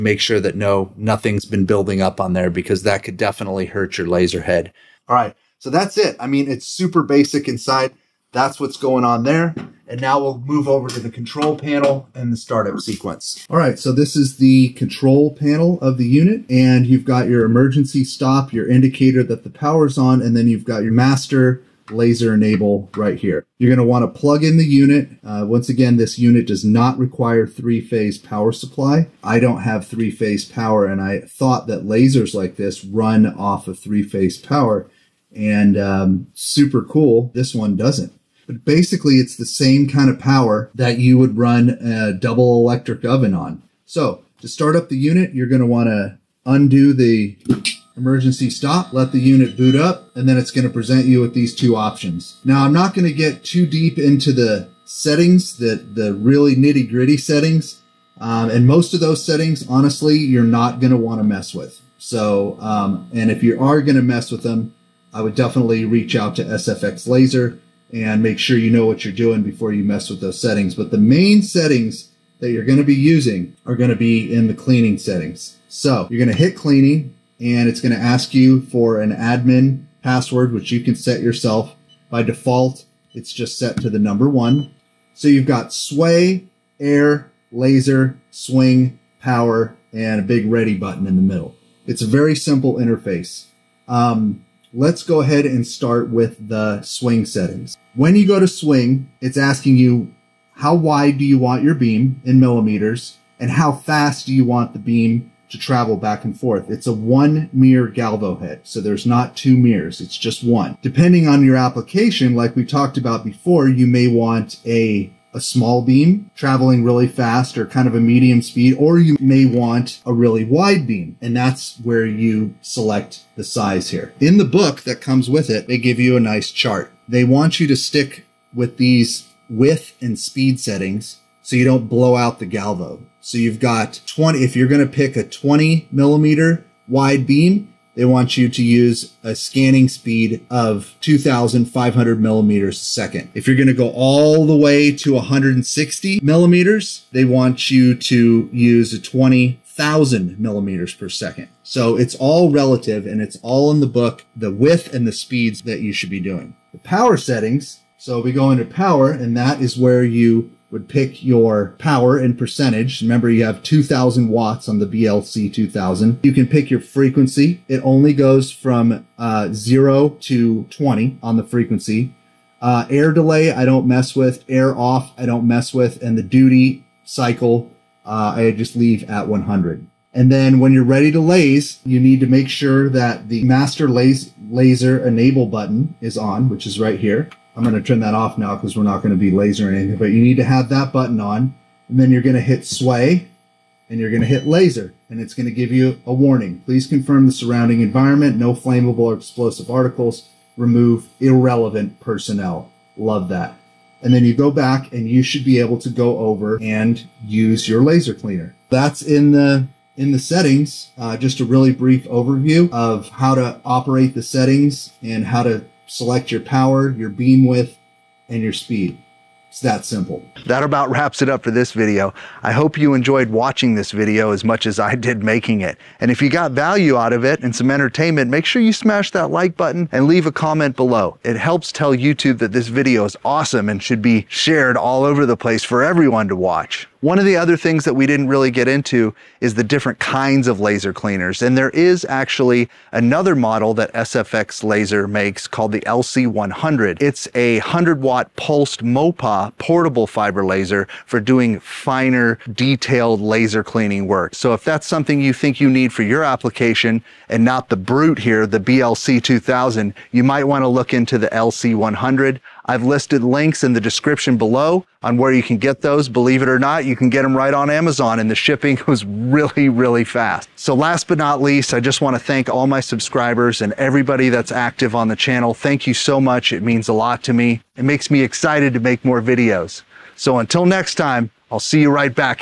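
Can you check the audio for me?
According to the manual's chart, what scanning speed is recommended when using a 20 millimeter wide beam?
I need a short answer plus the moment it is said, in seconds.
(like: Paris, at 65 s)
2,500 millimeters a second, at 140 s.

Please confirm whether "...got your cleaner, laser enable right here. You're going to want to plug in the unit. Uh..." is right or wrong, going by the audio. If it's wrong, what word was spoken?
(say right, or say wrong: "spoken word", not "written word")
wrong: "master", not "cleaner".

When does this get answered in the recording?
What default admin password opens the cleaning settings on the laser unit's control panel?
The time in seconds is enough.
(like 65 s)
83 s.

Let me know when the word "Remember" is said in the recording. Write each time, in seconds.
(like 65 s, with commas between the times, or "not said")
163 s.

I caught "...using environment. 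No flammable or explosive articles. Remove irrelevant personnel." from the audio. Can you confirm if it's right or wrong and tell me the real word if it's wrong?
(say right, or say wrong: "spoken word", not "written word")
wrong: "surrounding", not "using".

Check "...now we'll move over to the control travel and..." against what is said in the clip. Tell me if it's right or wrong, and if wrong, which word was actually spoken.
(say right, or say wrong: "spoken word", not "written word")
wrong: "panel", not "travel".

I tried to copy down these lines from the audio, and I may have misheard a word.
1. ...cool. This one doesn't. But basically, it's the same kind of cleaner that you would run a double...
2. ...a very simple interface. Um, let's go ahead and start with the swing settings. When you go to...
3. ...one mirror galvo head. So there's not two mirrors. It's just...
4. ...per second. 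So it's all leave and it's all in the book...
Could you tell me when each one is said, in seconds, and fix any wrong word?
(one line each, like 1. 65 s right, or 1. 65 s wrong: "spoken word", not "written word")
1. 36 s wrong: "power", not "cleaner"
2. 92 s right
3. 106 s right
4. 150 s wrong: "relative", not "leave".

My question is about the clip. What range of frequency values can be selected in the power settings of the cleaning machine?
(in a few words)
0 to 20.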